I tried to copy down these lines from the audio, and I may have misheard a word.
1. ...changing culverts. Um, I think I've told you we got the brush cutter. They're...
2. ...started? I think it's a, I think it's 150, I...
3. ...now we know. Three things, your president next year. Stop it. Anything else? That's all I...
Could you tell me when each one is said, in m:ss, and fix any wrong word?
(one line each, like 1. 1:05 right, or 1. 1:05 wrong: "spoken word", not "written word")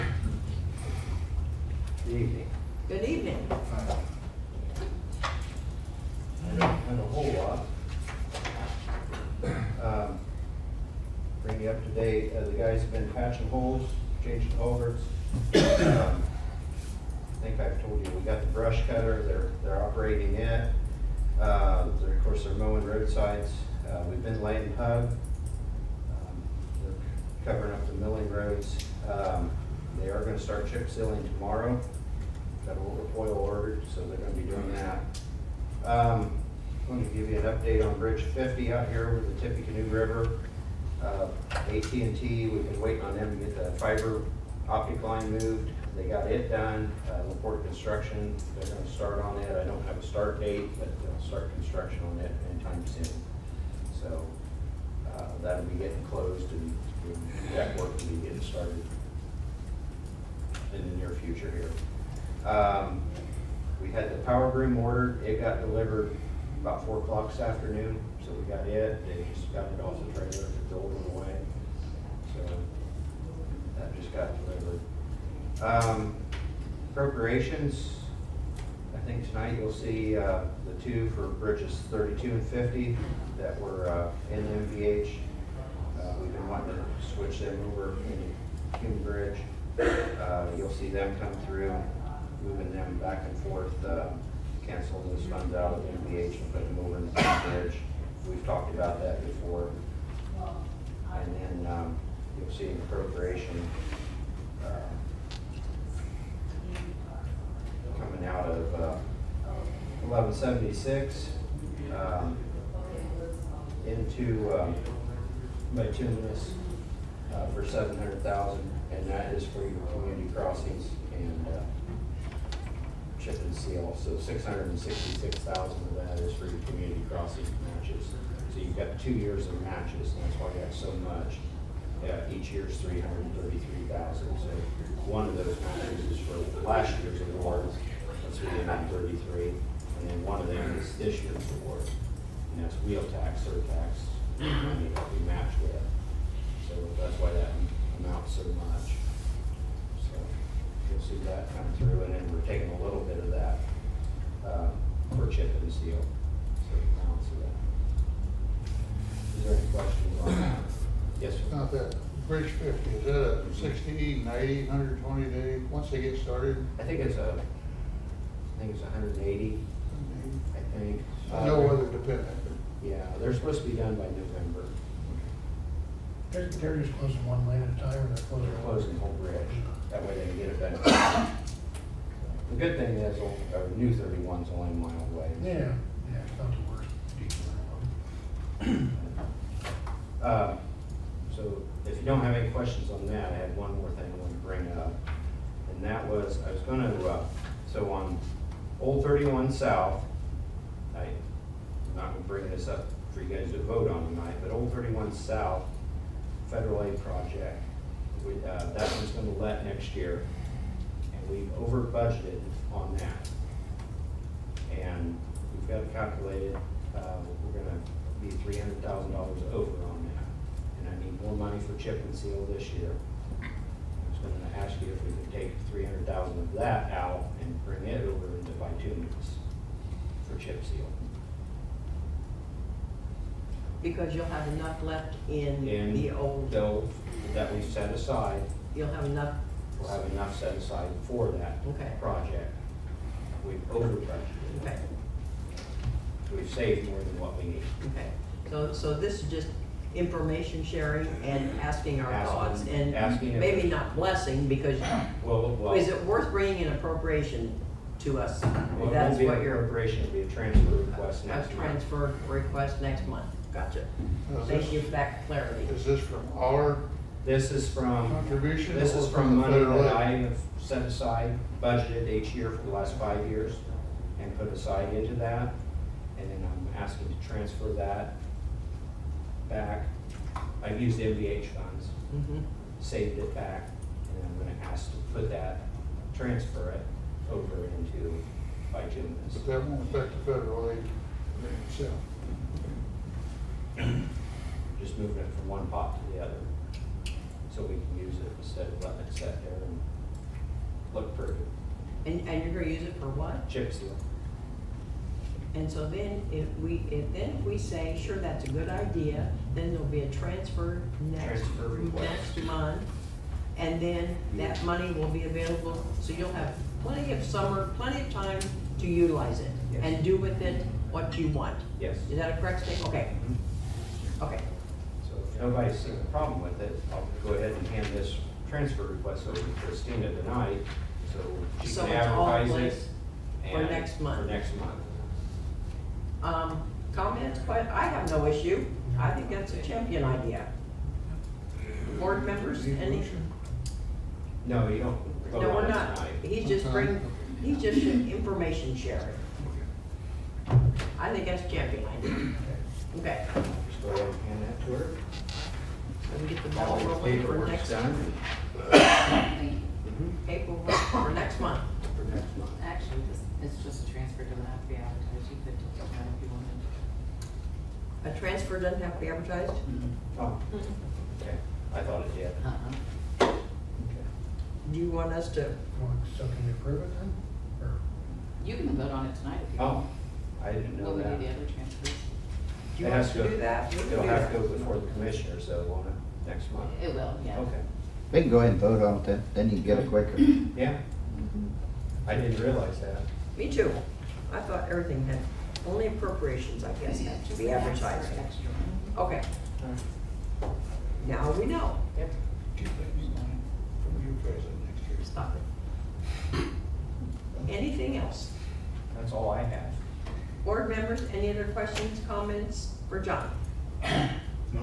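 1. 0:14 right
2. 2:46 wrong: "180", not "150"
3. 6:41 wrong: "Two", not "Three".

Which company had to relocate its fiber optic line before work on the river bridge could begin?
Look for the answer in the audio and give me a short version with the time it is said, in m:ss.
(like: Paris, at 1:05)
AT&T, at 0:41.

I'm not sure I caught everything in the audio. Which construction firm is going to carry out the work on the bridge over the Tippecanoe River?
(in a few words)
Laporte Construction.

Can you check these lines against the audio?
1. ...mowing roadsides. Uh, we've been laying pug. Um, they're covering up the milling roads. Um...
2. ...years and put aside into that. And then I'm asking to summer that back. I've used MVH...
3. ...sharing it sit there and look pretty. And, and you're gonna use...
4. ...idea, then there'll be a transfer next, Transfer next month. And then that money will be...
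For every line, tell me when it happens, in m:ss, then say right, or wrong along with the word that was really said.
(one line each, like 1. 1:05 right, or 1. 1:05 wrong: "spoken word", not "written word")
1. 0:22 right
2. 4:33 wrong: "transfer", not "summer"
3. 4:58 wrong: "letting", not "sharing"
4. 5:08 right.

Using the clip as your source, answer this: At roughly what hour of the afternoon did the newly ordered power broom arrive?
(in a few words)
4 o'clock.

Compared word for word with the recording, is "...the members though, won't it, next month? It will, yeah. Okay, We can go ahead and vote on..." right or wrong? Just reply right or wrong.
wrong.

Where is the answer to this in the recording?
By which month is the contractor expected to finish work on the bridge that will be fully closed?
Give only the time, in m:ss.
2:54.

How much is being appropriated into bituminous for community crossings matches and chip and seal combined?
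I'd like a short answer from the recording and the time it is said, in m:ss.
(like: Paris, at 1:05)
700,000, at 1:57.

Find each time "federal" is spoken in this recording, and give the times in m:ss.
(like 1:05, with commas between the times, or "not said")
3:26, 4:50.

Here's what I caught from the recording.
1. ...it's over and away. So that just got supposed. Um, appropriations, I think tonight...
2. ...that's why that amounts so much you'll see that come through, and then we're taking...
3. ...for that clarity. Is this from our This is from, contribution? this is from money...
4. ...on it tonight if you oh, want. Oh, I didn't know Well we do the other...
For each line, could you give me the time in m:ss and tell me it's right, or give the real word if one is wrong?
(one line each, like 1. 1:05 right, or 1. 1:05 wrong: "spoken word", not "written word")
1. 1:10 wrong: "delivered", not "supposed"
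2. 2:27 right
3. 4:24 right
4. 6:18 wrong: "What", not "Well".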